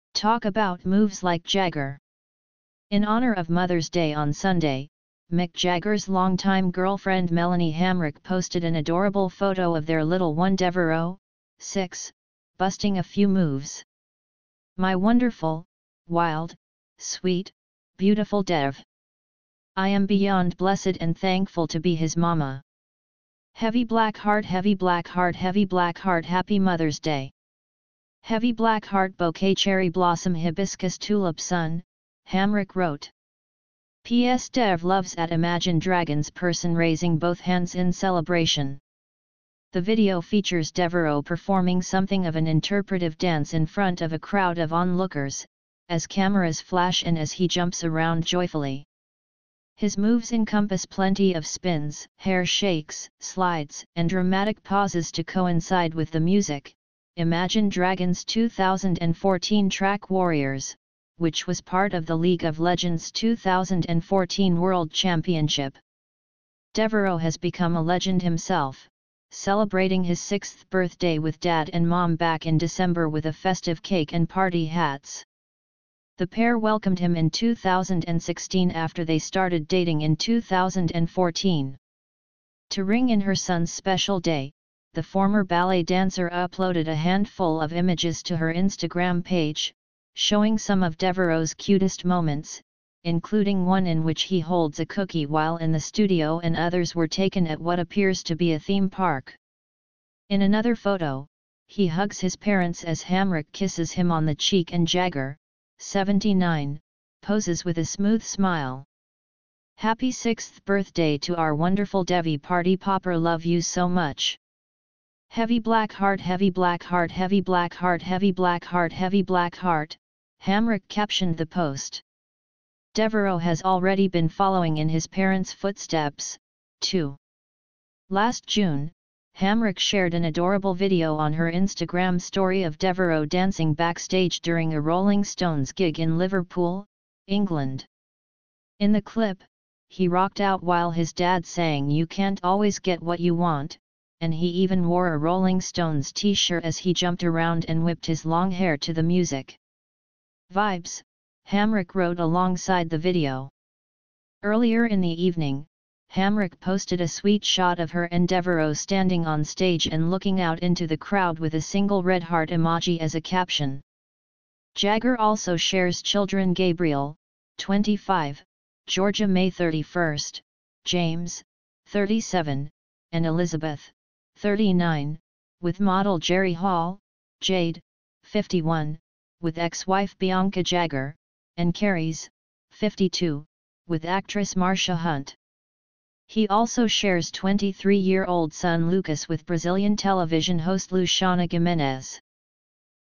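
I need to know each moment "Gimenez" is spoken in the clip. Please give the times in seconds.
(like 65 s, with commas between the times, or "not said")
191 s.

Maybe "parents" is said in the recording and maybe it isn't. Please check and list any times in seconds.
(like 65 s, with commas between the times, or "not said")
102 s, 125 s.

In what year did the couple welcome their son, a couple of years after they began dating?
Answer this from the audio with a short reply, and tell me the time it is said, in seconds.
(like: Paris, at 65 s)
2016, at 77 s.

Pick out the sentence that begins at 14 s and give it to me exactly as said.
My wonderful, wild, sweet, beautiful Dev.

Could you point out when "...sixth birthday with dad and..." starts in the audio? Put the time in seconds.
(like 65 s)
70 s.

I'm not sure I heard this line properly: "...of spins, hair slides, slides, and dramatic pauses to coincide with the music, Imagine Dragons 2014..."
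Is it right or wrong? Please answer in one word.
wrong.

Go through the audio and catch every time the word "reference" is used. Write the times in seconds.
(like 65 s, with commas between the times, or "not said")
not said.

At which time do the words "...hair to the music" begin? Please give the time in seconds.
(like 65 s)
148 s.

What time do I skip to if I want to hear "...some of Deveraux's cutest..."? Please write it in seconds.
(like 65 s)
90 s.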